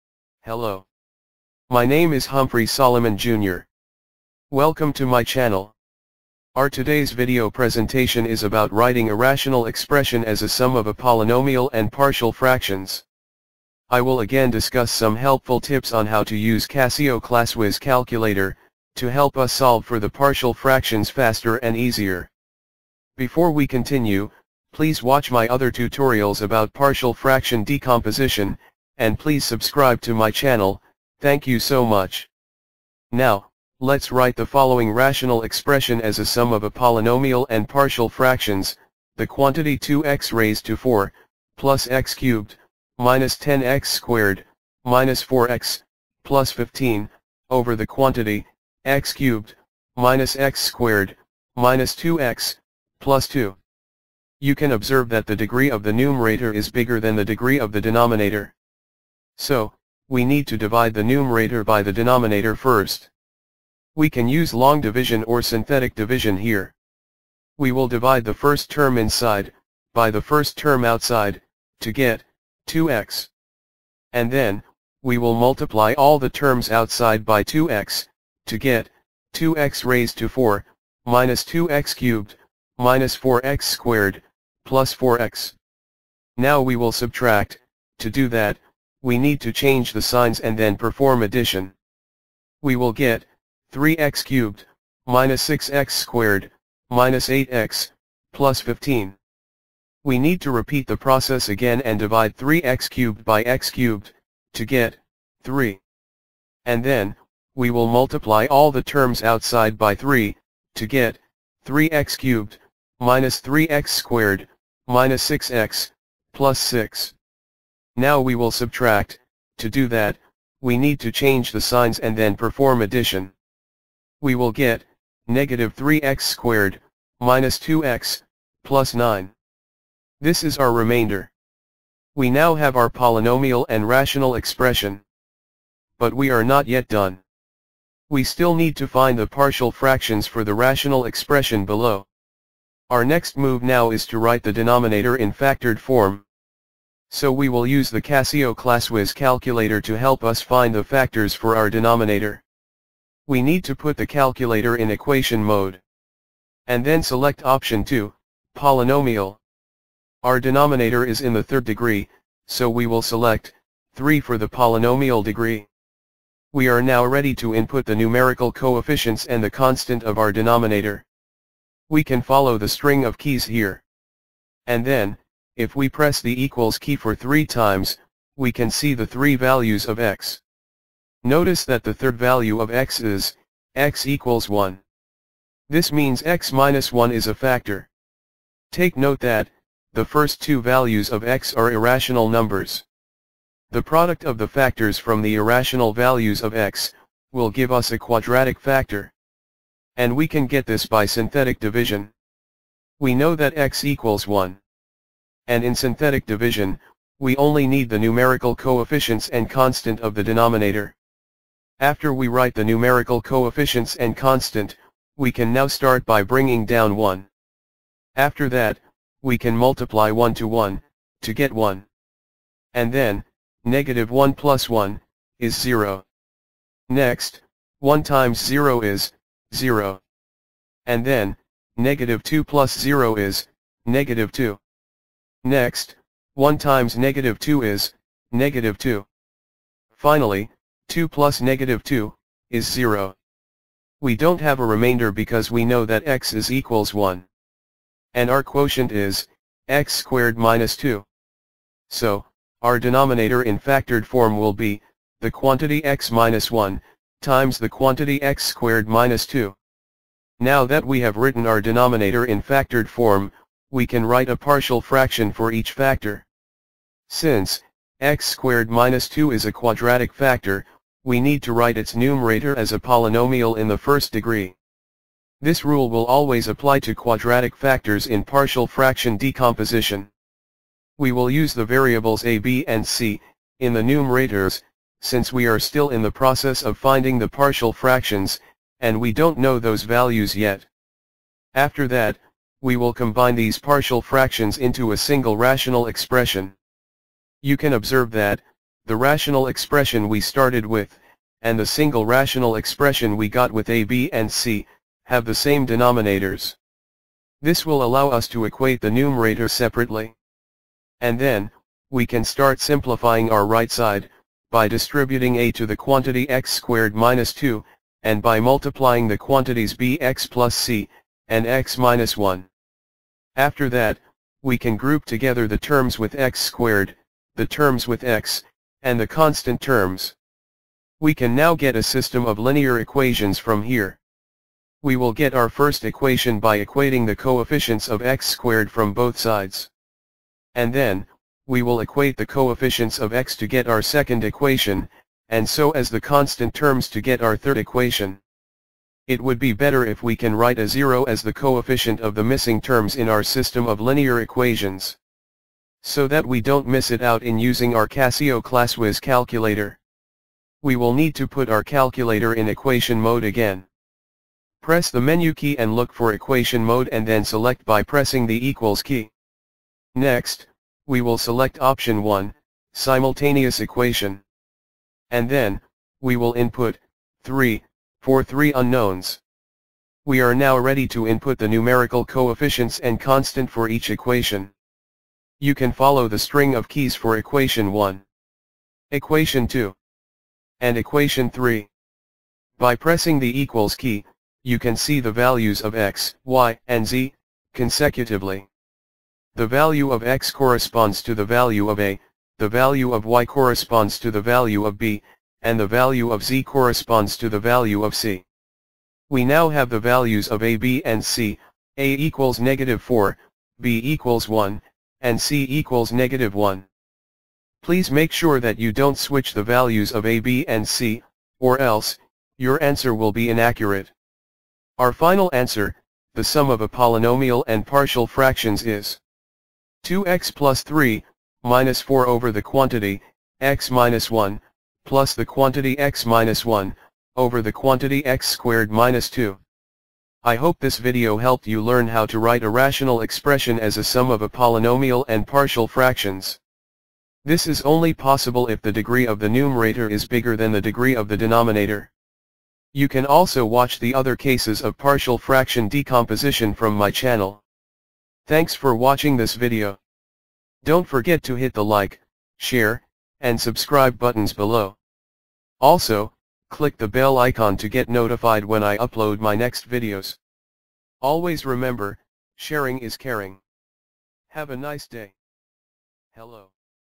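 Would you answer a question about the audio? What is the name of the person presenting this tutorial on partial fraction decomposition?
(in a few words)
Humphrey Soliman Jr.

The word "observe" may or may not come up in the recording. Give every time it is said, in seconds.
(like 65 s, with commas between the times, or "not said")
54 s, 297 s.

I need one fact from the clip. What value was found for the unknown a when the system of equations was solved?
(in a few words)
-4.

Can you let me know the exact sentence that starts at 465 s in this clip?
Also, click the bell icon to get notified when I upload my next videos.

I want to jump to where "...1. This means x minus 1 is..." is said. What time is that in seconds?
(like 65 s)
184 s.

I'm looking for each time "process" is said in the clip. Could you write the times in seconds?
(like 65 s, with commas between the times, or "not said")
100 s, 286 s.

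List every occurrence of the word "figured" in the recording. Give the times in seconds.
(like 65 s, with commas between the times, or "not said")
not said.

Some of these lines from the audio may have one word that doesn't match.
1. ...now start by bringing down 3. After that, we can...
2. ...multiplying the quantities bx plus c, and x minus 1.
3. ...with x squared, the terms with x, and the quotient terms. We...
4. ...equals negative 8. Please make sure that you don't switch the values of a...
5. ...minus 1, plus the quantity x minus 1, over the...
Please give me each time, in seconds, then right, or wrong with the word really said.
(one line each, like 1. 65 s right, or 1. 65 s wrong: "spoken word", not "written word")
1. 215 s wrong: "1", not "3"
2. 318 s right
3. 325 s wrong: "constant", not "quotient"
4. 415 s wrong: "1", not "8"
5. 433 s right.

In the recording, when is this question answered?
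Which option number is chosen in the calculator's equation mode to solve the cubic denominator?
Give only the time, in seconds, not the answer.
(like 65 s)
157 s.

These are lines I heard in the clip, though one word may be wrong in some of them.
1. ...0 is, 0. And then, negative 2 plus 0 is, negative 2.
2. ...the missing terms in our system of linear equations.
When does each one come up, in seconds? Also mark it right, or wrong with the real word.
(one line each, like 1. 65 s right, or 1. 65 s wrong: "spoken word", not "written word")
1. 228 s right
2. 352 s right.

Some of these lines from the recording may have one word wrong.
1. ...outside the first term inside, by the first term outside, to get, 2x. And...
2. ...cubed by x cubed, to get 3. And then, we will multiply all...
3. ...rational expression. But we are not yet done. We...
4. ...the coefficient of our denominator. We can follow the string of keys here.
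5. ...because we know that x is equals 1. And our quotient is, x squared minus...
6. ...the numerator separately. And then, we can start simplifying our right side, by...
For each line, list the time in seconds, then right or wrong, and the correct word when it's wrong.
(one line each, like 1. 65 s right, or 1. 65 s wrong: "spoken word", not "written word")
1. 67 s wrong: "divide", not "outside"
2. 102 s right
3. 133 s right
4. 169 s wrong: "constant", not "coefficient"
5. 245 s right
6. 308 s right.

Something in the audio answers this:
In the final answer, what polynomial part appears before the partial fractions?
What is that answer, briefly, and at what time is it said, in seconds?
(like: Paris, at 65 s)
2x plus 3, at 429 s.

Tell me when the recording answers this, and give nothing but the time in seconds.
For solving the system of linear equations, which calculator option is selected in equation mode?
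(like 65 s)
372 s.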